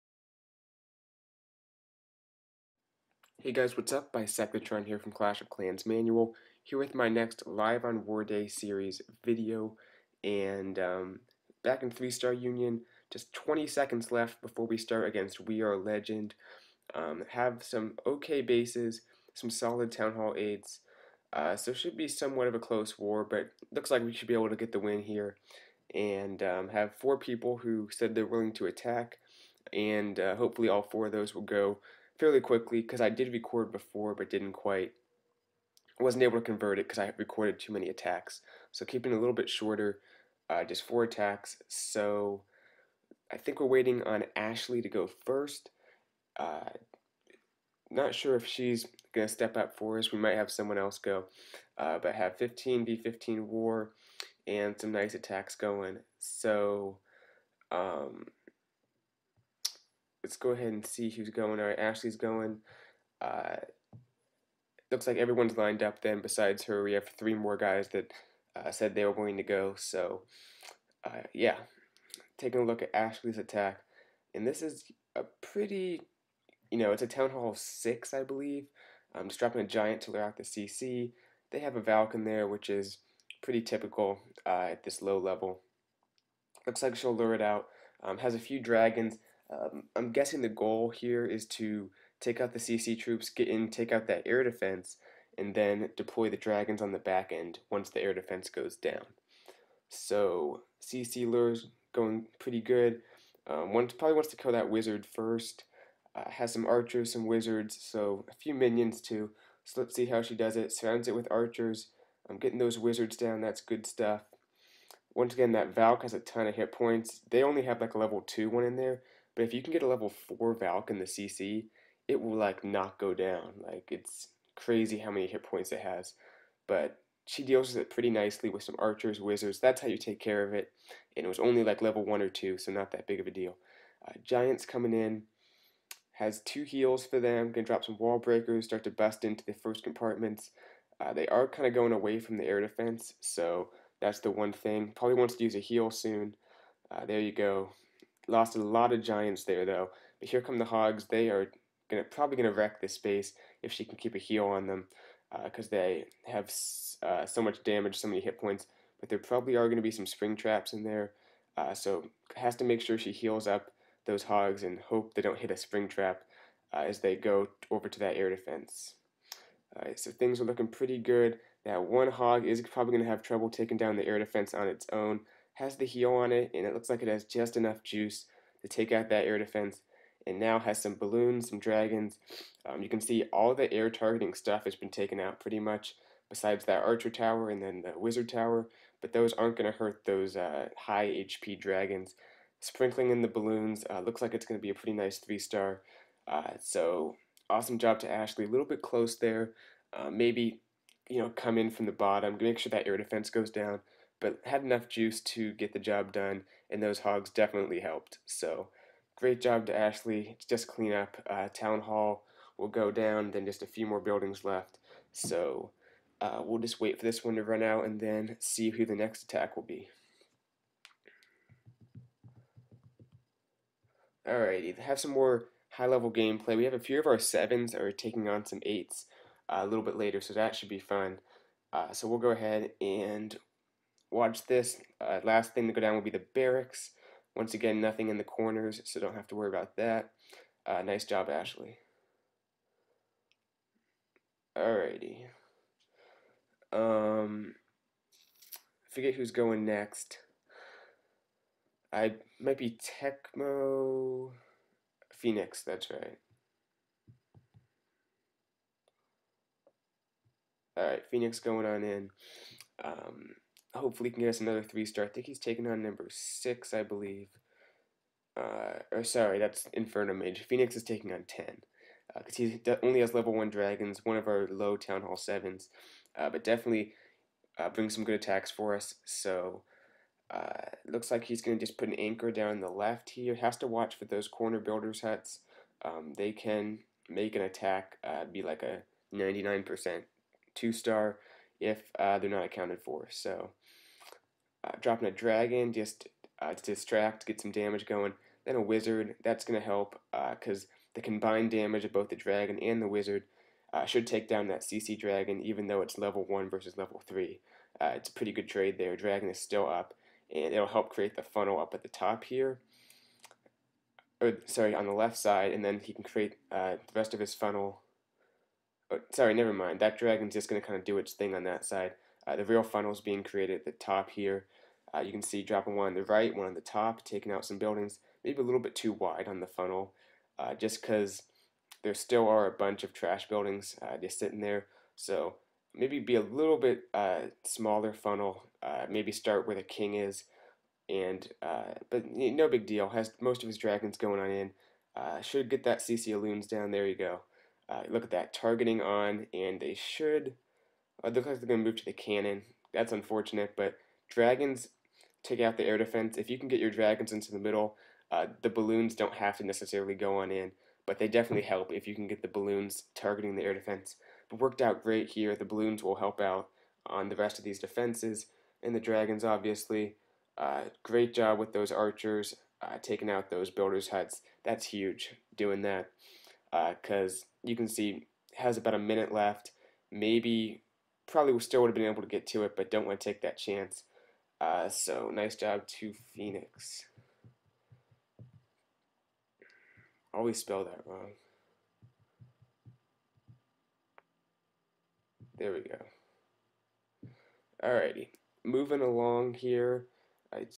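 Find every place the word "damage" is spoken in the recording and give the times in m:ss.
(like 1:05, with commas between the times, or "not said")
2:37, 4:57, 5:01.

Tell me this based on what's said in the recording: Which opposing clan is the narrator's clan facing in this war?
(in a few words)
We Are Legend.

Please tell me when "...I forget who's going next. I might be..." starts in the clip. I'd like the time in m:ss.
4:08.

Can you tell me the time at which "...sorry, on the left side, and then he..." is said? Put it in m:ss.
5:14.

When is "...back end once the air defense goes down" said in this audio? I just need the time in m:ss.
1:36.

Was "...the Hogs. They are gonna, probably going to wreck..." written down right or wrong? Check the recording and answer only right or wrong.
right.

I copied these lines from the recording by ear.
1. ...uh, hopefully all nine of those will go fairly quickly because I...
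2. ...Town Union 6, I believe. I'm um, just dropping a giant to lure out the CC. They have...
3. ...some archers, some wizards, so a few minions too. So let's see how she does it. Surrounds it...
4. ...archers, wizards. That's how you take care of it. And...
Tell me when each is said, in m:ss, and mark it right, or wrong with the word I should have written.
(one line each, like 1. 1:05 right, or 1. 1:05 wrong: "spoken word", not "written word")
1. 0:30 wrong: "four", not "nine"
2. 1:17 wrong: "Hall", not "Union"
3. 1:46 right
4. 2:08 right.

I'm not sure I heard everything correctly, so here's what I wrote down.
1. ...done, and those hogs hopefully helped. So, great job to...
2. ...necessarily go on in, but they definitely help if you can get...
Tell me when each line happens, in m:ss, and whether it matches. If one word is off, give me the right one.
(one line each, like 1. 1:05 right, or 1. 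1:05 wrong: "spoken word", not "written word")
1. 3:26 wrong: "definitely", not "hopefully"
2. 5:59 right.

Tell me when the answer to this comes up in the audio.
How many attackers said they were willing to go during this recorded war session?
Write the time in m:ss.
0:26.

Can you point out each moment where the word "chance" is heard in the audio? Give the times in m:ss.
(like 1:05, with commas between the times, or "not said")
6:23.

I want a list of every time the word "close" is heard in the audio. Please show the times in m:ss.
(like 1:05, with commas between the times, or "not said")
0:22, 3:18.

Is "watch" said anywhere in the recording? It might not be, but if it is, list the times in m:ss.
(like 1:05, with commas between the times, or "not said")
3:54, 4:43.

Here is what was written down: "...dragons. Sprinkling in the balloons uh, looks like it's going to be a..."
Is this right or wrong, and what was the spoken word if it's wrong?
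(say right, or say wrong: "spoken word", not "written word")
right.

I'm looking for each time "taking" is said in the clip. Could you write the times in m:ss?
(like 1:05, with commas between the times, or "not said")
1:12, 2:53, 3:47, 4:25, 4:30, 5:27, 6:12.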